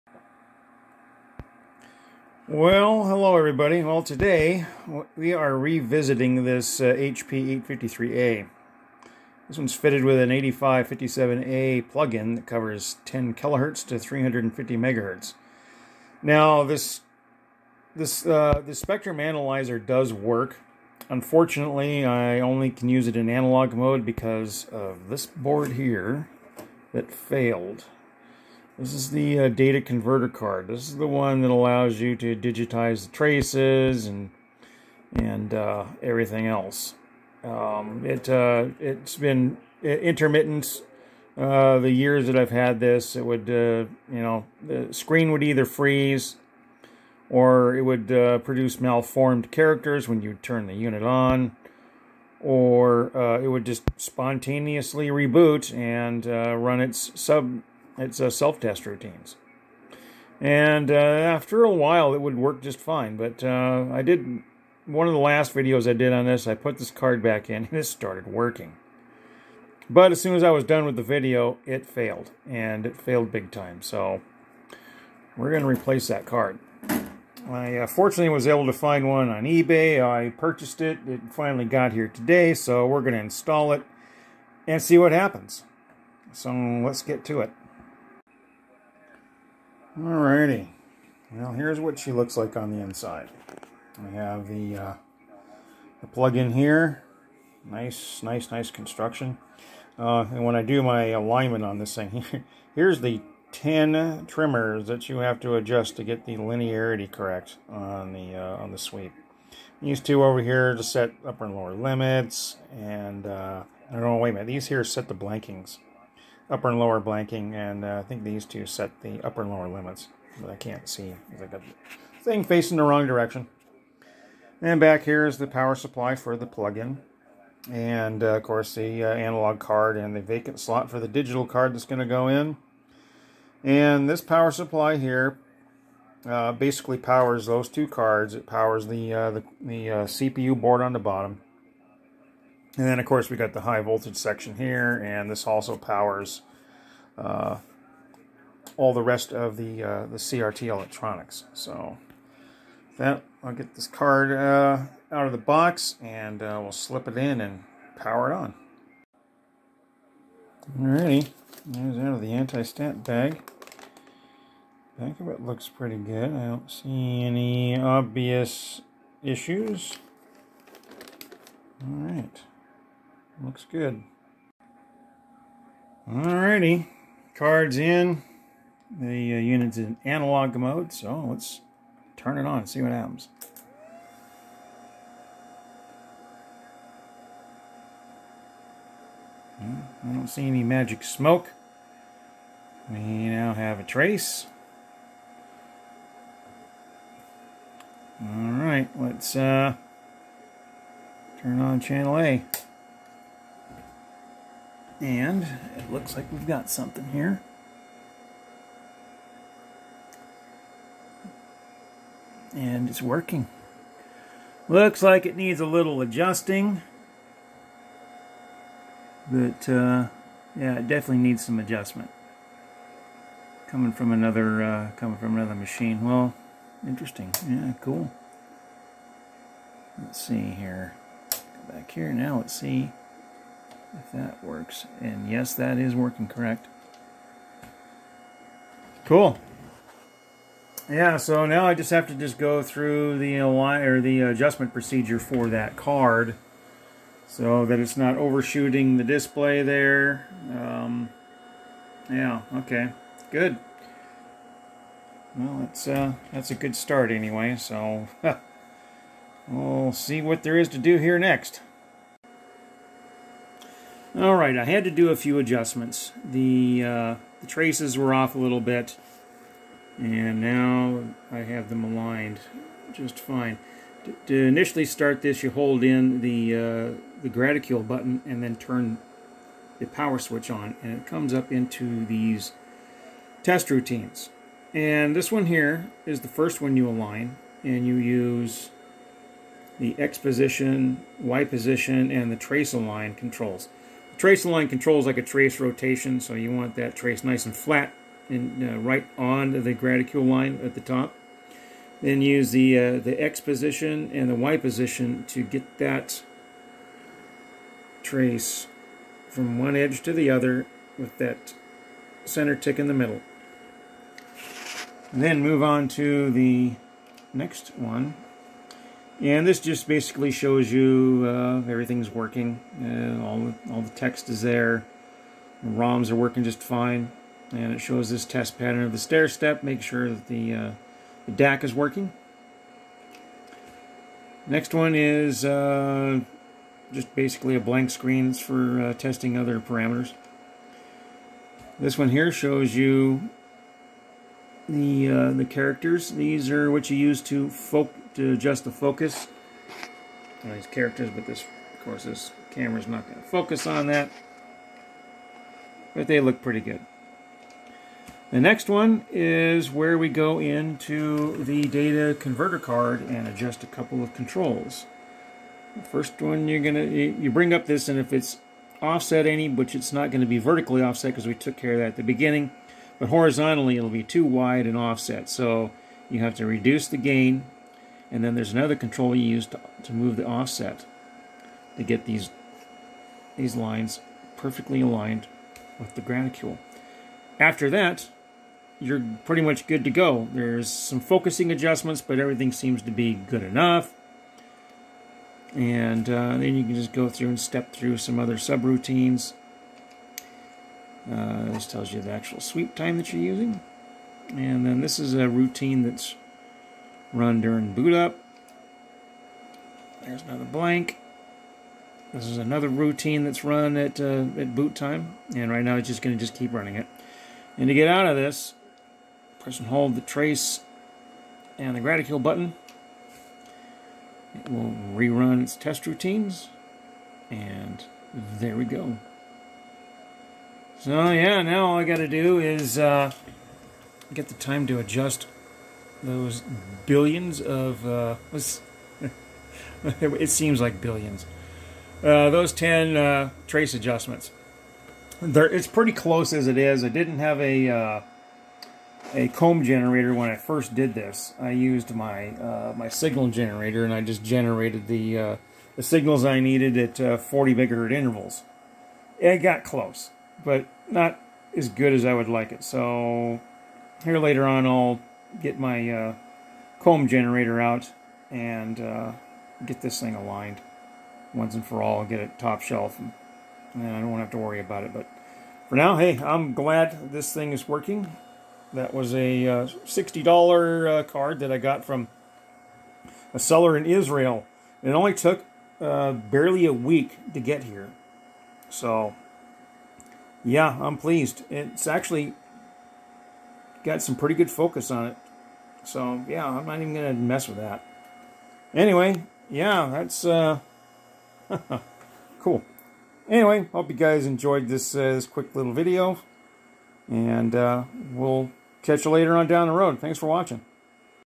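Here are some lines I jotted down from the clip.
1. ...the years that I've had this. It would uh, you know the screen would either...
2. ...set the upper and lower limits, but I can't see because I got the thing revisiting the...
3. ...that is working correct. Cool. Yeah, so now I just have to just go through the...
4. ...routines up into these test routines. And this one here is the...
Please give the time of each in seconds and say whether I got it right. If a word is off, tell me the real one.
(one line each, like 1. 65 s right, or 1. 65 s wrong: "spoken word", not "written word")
1. 41 s right
2. 118 s wrong: "facing", not "revisiting"
3. 235 s right
4. 281 s wrong: "comes", not "routines".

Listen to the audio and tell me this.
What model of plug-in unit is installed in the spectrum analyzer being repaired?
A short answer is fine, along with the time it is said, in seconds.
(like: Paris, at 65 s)
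8557A, at 10 s.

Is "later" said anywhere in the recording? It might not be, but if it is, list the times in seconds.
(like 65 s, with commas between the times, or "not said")
464 s, 509 s.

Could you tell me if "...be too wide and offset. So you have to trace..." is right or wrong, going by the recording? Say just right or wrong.
wrong.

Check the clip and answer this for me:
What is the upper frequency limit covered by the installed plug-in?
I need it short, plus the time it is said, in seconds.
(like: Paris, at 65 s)
350 megahertz, at 13 s.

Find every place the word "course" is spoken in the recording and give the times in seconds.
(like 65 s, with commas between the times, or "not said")
128 s, 143 s, 351 s.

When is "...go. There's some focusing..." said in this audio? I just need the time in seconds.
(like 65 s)
389 s.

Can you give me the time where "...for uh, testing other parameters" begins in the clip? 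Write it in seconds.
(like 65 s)
338 s.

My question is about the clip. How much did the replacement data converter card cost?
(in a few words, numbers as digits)
$60.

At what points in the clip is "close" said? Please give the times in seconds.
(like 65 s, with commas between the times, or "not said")
445 s, 459 s.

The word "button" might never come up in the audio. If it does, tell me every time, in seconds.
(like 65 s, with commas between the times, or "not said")
277 s, 422 s.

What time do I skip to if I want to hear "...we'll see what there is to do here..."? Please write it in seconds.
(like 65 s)
259 s.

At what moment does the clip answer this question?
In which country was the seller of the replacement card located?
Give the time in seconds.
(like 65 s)
483 s.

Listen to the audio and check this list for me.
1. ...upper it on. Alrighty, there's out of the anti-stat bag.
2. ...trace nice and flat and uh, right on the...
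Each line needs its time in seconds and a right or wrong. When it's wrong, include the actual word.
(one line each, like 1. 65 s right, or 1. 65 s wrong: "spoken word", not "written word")
1. 157 s wrong: "power", not "upper"
2. 296 s right.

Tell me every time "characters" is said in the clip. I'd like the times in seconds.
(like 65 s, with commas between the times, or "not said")
49 s, 345 s, 350 s.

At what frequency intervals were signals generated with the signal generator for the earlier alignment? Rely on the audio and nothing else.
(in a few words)
40 megahertz.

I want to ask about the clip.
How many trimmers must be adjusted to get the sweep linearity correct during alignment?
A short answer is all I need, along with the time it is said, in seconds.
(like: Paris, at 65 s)
10, at 103 s.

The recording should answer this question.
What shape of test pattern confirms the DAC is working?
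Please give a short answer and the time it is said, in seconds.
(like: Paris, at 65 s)
stair step, at 328 s.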